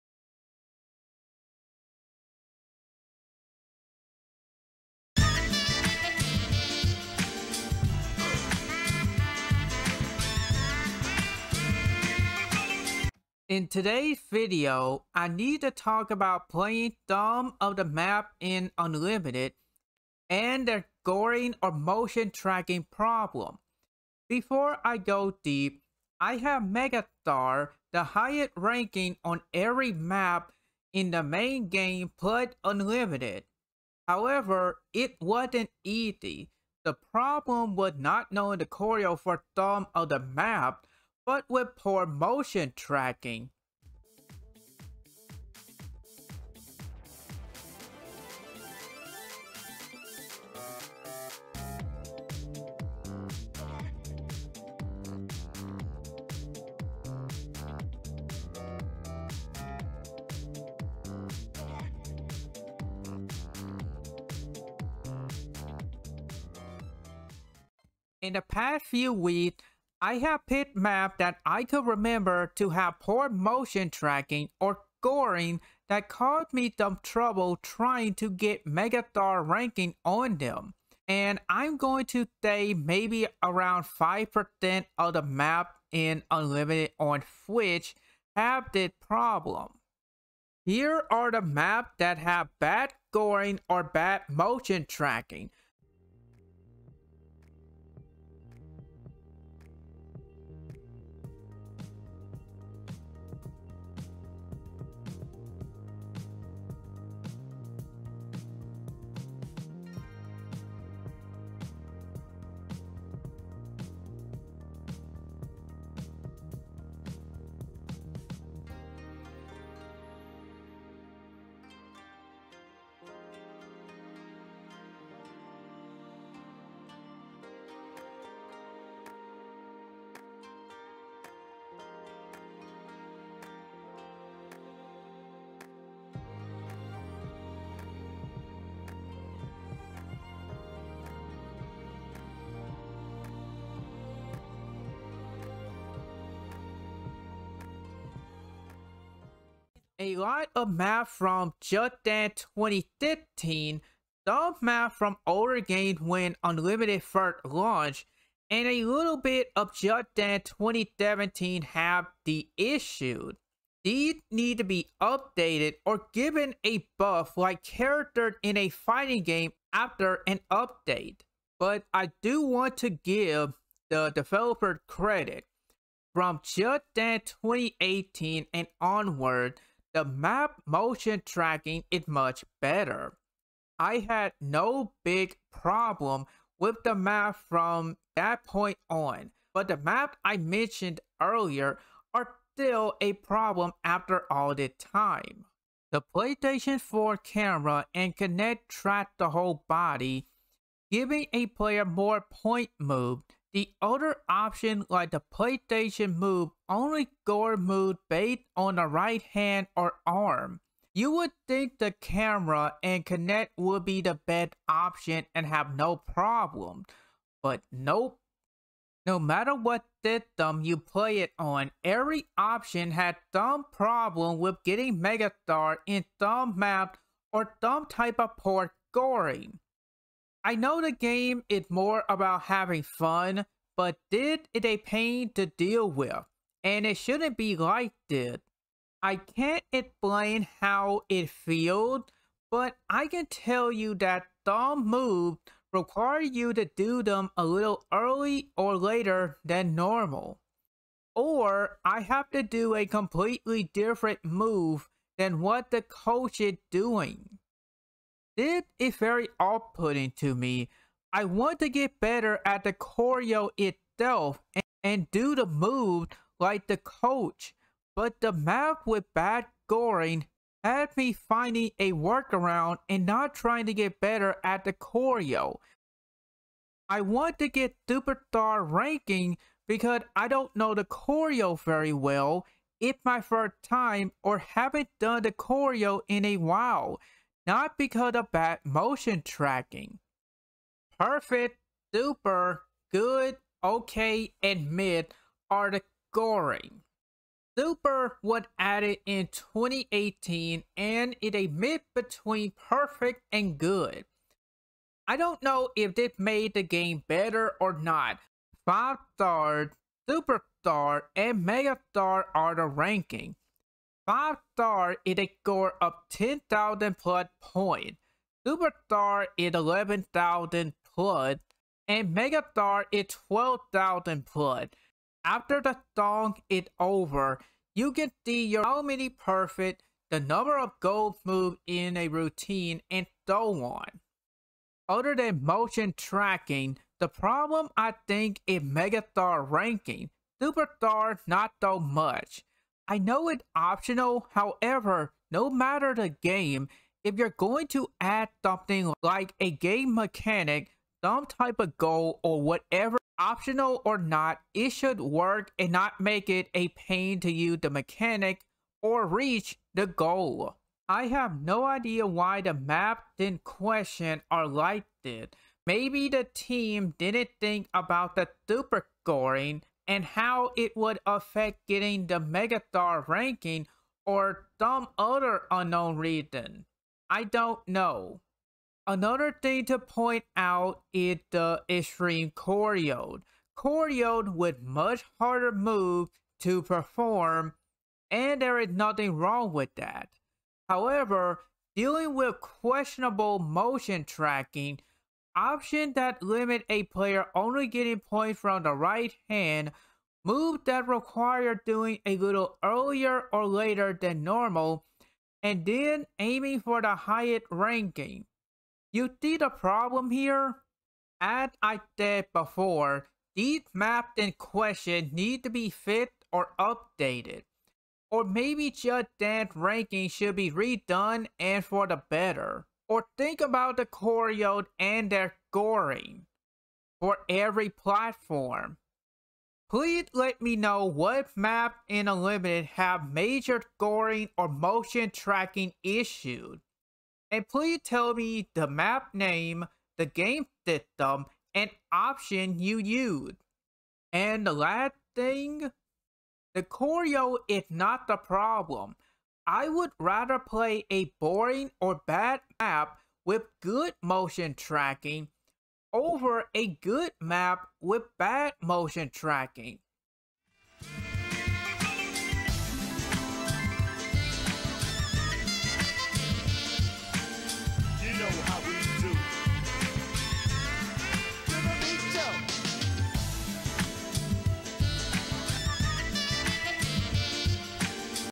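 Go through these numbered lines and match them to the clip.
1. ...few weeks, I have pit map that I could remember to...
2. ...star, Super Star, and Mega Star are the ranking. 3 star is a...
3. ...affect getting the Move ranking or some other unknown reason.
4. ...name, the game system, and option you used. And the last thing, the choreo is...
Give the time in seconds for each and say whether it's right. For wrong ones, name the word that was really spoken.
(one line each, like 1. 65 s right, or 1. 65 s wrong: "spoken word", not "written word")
1. 68 s right
2. 309 s wrong: "5", not "3"
3. 371 s wrong: "Megastar", not "Move"
4. 439 s right.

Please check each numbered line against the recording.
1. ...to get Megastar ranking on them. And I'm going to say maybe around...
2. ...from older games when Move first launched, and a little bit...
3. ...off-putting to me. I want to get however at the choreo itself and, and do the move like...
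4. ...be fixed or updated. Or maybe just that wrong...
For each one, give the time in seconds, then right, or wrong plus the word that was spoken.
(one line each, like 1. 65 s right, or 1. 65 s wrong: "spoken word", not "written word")
1. 78 s right
2. 154 s wrong: "Unlimited", not "Move"
3. 259 s wrong: "better", not "however"
4. 415 s wrong: "ranking", not "wrong".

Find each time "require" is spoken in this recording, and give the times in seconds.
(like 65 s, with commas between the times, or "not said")
245 s, 400 s.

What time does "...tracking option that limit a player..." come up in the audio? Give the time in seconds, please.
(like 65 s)
394 s.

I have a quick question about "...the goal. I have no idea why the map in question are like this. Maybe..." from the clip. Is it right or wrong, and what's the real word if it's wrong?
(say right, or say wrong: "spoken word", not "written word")
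right.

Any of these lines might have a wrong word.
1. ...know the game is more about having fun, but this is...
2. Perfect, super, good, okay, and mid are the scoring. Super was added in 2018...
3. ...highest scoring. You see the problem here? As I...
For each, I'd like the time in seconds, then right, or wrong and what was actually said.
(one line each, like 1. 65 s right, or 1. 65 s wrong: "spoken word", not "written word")
1. 230 s right
2. 290 s right
3. 406 s wrong: "ranking", not "scoring".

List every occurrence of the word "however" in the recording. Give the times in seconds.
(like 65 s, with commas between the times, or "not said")
34 s, 344 s, 390 s.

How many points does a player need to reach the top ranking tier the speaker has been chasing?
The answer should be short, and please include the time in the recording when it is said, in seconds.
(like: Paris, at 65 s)
12,000, at 323 s.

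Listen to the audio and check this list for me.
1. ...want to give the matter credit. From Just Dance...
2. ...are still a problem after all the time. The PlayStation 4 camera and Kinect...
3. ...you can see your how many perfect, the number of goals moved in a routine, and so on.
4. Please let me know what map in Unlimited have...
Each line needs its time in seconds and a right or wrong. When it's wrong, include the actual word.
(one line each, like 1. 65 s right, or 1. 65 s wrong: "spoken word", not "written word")
1. 172 s wrong: "developer", not "matter"
2. 192 s right
3. 327 s right
4. 429 s right.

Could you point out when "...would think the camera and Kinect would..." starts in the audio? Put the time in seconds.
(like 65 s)
211 s.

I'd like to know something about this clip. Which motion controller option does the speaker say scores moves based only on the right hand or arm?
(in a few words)
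PlayStation Move.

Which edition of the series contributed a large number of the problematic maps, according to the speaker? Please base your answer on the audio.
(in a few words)
Just Dance 2015.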